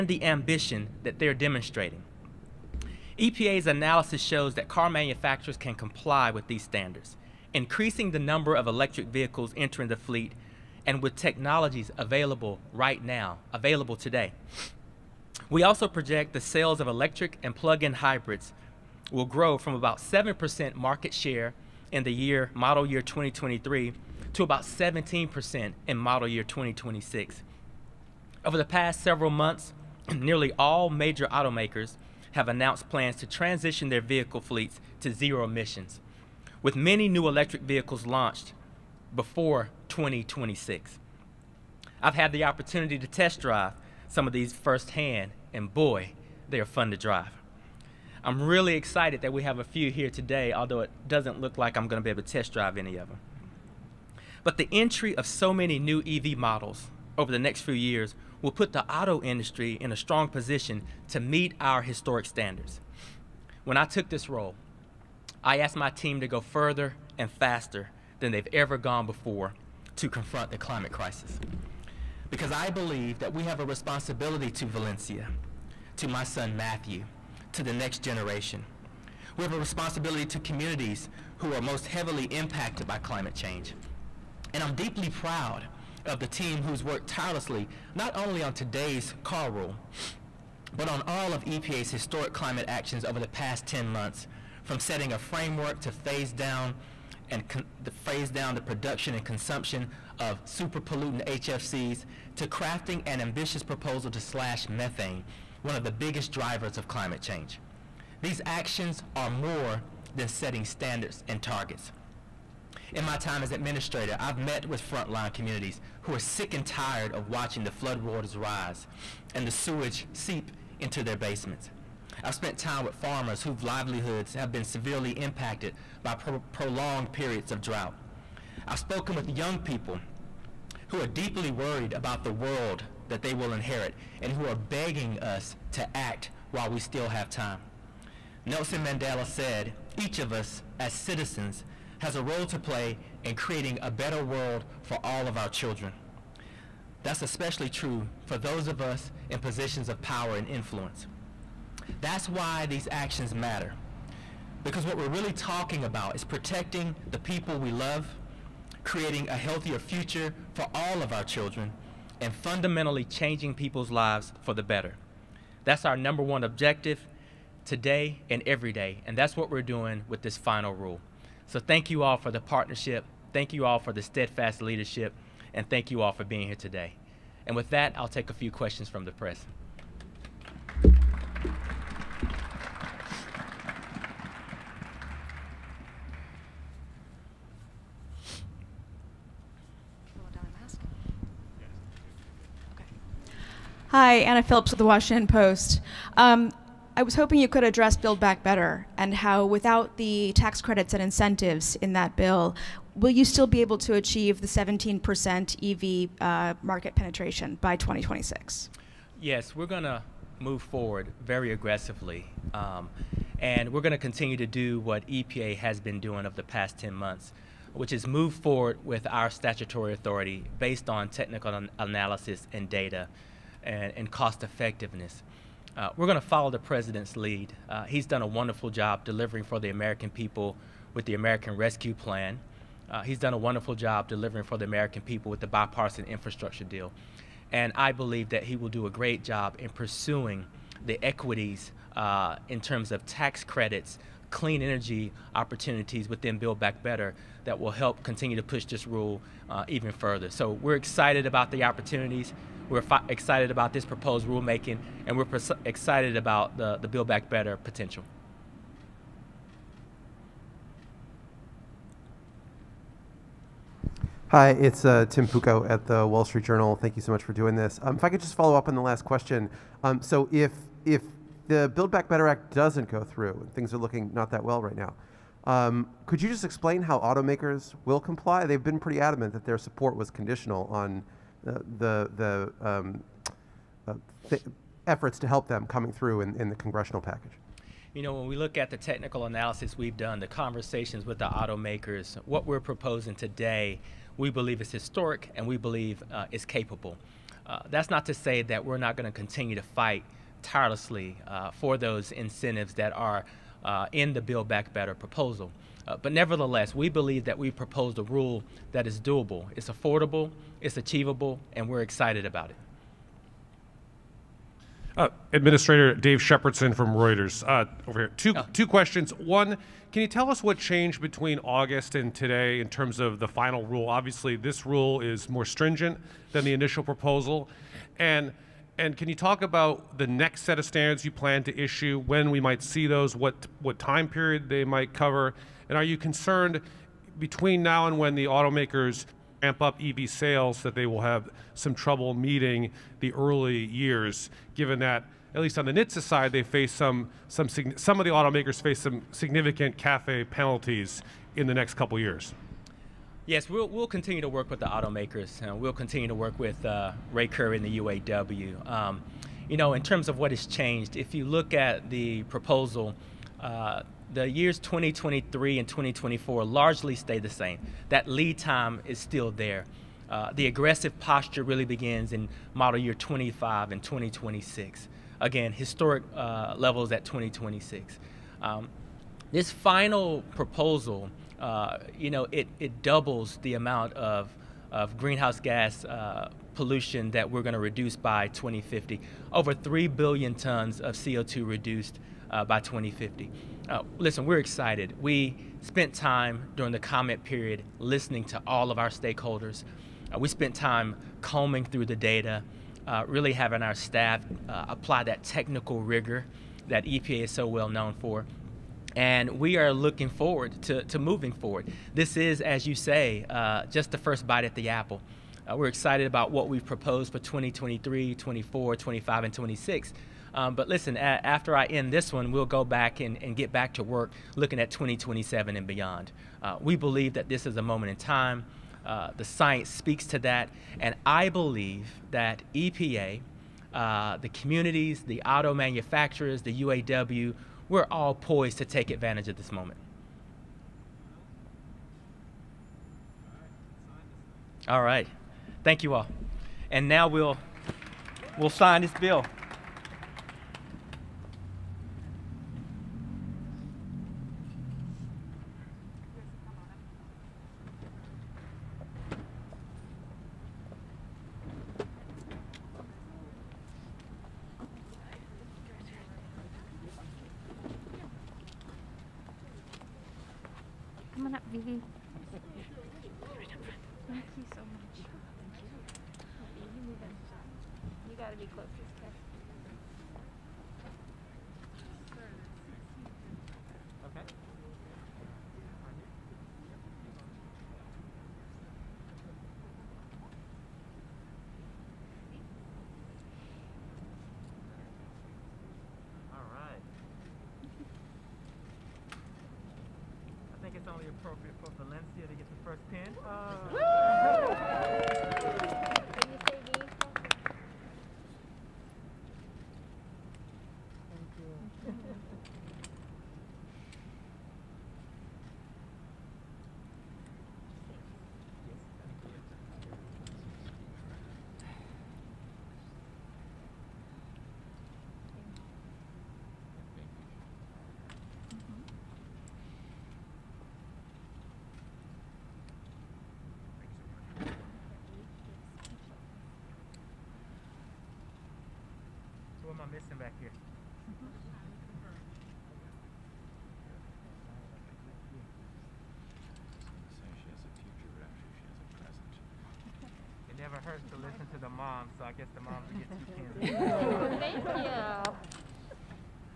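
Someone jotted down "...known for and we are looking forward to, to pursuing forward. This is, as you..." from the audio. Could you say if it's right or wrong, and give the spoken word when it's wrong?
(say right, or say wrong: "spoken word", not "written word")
wrong: "moving", not "pursuing".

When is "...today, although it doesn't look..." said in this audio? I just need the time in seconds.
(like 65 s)
50 s.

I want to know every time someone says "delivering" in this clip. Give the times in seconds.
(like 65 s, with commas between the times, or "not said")
229 s, 234 s.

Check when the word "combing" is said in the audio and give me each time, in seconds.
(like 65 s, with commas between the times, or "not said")
401 s.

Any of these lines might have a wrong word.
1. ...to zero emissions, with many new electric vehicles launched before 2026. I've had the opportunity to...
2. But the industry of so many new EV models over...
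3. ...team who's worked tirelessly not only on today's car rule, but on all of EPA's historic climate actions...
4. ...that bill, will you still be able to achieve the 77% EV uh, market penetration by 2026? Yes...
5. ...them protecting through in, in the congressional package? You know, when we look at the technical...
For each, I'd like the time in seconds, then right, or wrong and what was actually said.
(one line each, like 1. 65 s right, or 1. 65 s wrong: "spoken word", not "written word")
1. 34 s right
2. 54 s wrong: "entry", not "industry"
3. 86 s right
4. 201 s wrong: "17", not "77"
5. 285 s wrong: "coming", not "protecting".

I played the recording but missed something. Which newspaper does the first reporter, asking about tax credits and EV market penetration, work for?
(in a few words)
The Washington Post.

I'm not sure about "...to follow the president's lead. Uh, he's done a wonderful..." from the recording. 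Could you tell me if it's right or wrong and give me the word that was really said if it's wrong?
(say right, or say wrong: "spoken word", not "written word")
right.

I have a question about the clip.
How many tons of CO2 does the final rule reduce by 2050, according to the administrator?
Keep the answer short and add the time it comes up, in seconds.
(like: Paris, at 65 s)
Over 3 billion tons, at 389 s.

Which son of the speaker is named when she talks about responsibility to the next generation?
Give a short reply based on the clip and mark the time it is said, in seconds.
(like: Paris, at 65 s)
Matthew, at 76 s.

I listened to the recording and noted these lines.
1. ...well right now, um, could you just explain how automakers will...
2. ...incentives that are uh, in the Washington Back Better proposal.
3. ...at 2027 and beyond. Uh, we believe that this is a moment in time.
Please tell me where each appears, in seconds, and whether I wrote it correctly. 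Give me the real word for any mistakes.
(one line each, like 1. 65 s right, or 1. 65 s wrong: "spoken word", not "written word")
1. 274 s right
2. 302 s wrong: "Build", not "Washington"
3. 424 s right.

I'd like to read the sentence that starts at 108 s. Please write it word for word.
These actions are more than setting standards and targets.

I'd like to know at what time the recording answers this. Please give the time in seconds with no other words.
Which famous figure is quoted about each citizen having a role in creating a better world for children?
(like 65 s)
138 s.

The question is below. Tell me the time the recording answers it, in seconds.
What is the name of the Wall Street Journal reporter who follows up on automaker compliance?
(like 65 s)
265 s.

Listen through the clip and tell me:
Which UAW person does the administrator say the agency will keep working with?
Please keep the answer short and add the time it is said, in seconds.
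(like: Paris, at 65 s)
Ray Curry, at 357 s.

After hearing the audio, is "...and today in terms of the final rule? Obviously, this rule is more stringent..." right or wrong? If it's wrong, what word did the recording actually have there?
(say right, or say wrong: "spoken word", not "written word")
right.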